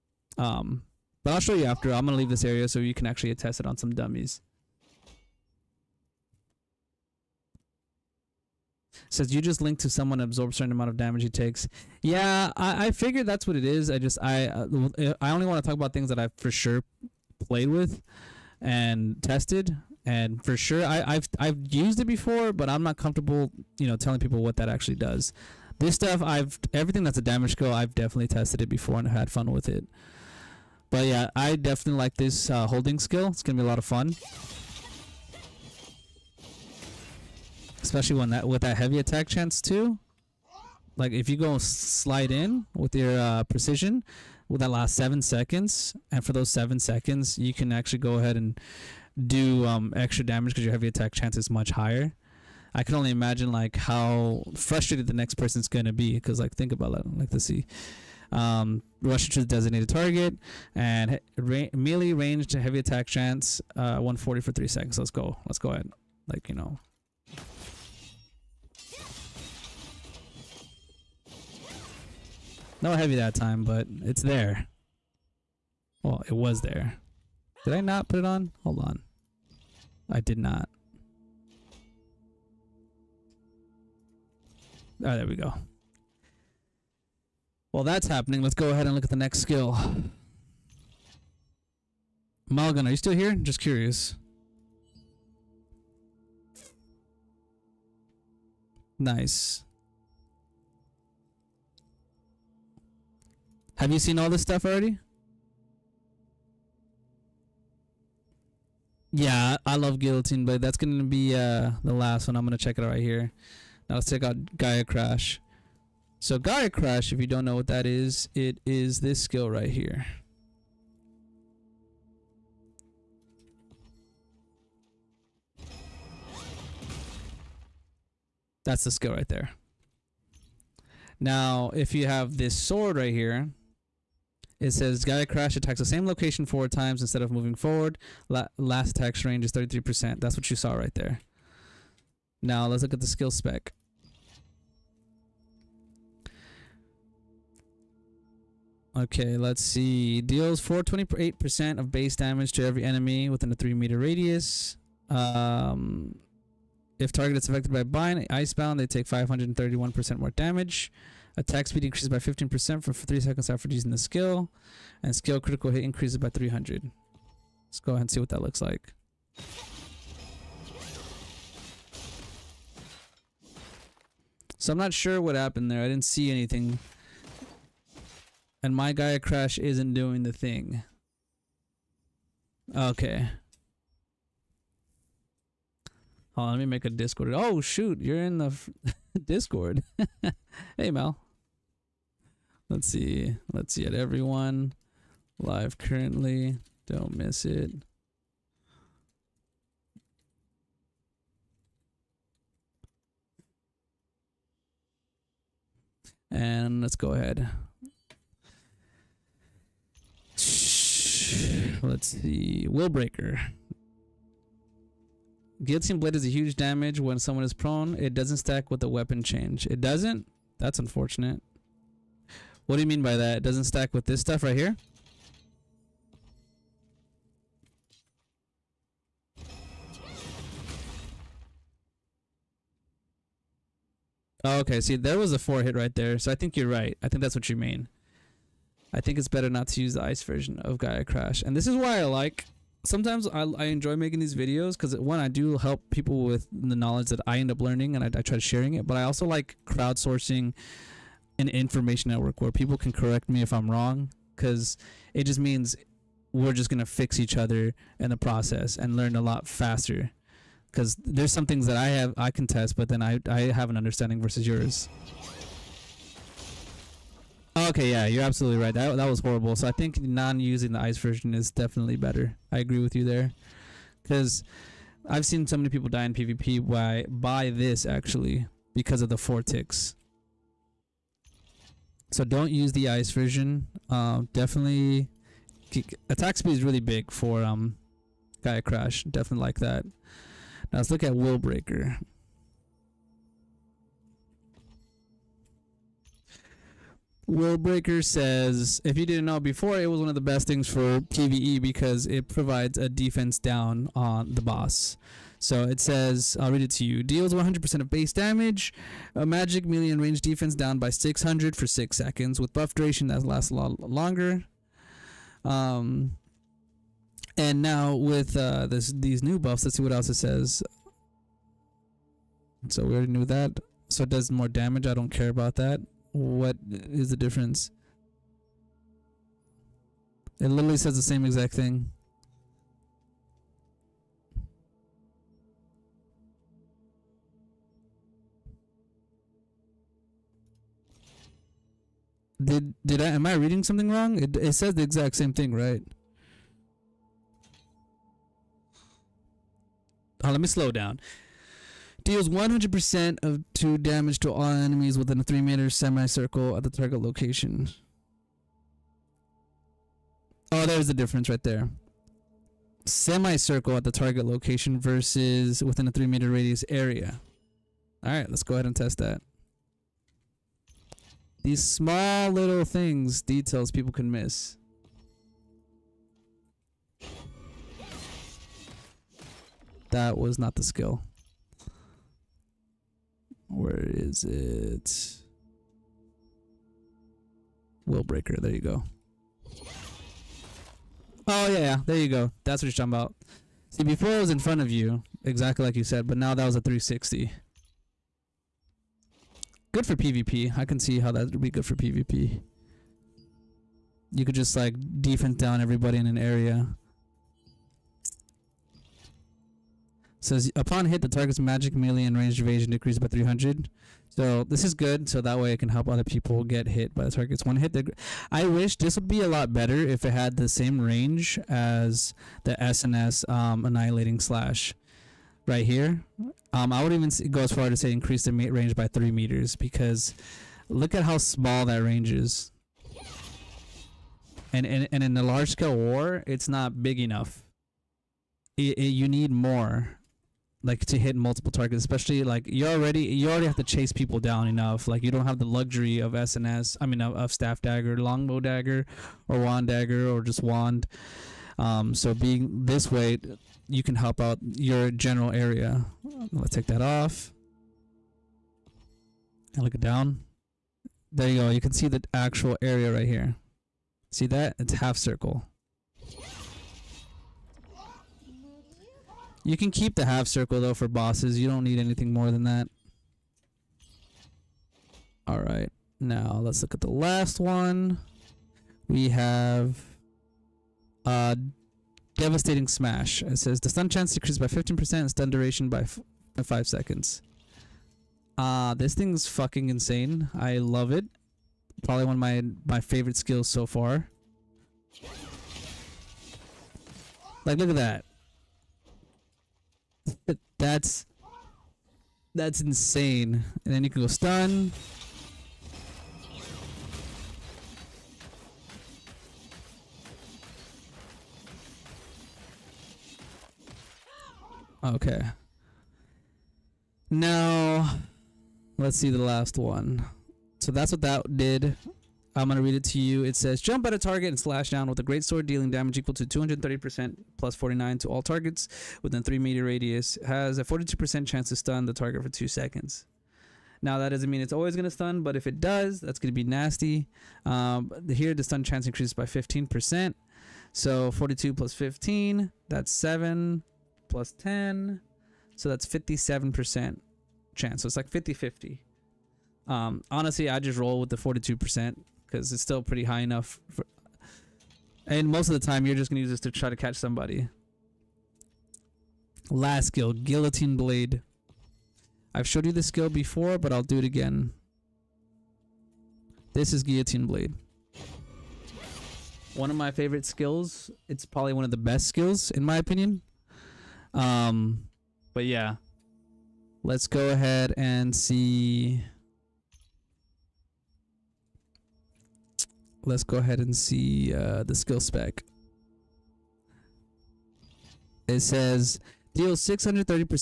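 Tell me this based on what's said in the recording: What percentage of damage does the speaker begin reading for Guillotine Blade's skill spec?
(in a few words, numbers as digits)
630%.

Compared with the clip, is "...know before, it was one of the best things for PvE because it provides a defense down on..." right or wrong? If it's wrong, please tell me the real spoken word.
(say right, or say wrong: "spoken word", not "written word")
right.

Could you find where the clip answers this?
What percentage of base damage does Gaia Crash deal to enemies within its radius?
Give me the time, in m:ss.
2:30.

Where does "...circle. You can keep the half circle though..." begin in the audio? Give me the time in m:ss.
7:44.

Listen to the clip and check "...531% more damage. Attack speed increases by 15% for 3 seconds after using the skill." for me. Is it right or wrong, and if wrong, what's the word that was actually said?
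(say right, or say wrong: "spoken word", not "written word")
right.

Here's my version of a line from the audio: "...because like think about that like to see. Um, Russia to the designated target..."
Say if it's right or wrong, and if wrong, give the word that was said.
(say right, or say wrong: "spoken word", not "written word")
right.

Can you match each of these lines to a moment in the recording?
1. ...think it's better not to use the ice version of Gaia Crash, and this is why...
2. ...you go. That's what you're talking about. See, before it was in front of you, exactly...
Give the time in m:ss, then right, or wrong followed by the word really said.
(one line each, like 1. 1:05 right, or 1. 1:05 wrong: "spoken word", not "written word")
1. 3:59 right
2. 6:31 right.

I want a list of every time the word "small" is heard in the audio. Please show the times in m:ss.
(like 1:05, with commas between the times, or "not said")
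6:11, 7:11.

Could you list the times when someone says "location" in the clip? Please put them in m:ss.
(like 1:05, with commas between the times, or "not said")
2:16, 5:57, 6:04.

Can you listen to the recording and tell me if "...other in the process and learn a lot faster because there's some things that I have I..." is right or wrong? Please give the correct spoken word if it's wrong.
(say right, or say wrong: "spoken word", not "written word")
right.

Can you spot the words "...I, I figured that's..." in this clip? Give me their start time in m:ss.
0:12.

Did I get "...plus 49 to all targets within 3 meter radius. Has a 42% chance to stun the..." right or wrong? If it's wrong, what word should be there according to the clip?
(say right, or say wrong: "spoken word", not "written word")
right.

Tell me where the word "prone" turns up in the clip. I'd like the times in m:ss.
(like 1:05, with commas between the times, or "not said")
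3:37.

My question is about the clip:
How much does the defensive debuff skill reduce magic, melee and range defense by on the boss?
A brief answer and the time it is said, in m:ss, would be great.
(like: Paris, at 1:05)
600, at 5:10.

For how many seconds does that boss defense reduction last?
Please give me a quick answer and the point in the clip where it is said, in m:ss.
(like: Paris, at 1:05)
6 seconds, at 5:11.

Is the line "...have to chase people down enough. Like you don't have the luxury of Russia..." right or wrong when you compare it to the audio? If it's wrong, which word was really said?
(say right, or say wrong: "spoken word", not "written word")
wrong: "SNS", not "Russia".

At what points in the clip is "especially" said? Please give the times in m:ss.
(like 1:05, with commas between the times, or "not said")
0:37, 7:21.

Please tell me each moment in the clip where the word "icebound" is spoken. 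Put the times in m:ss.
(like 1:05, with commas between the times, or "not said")
2:38.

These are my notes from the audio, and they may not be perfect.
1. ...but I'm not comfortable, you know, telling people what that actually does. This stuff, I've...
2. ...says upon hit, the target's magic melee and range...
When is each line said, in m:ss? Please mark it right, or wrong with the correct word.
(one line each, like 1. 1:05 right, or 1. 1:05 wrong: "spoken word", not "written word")
1. 0:22 right
2. 6:50 right.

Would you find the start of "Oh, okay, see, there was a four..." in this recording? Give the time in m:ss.
3:54.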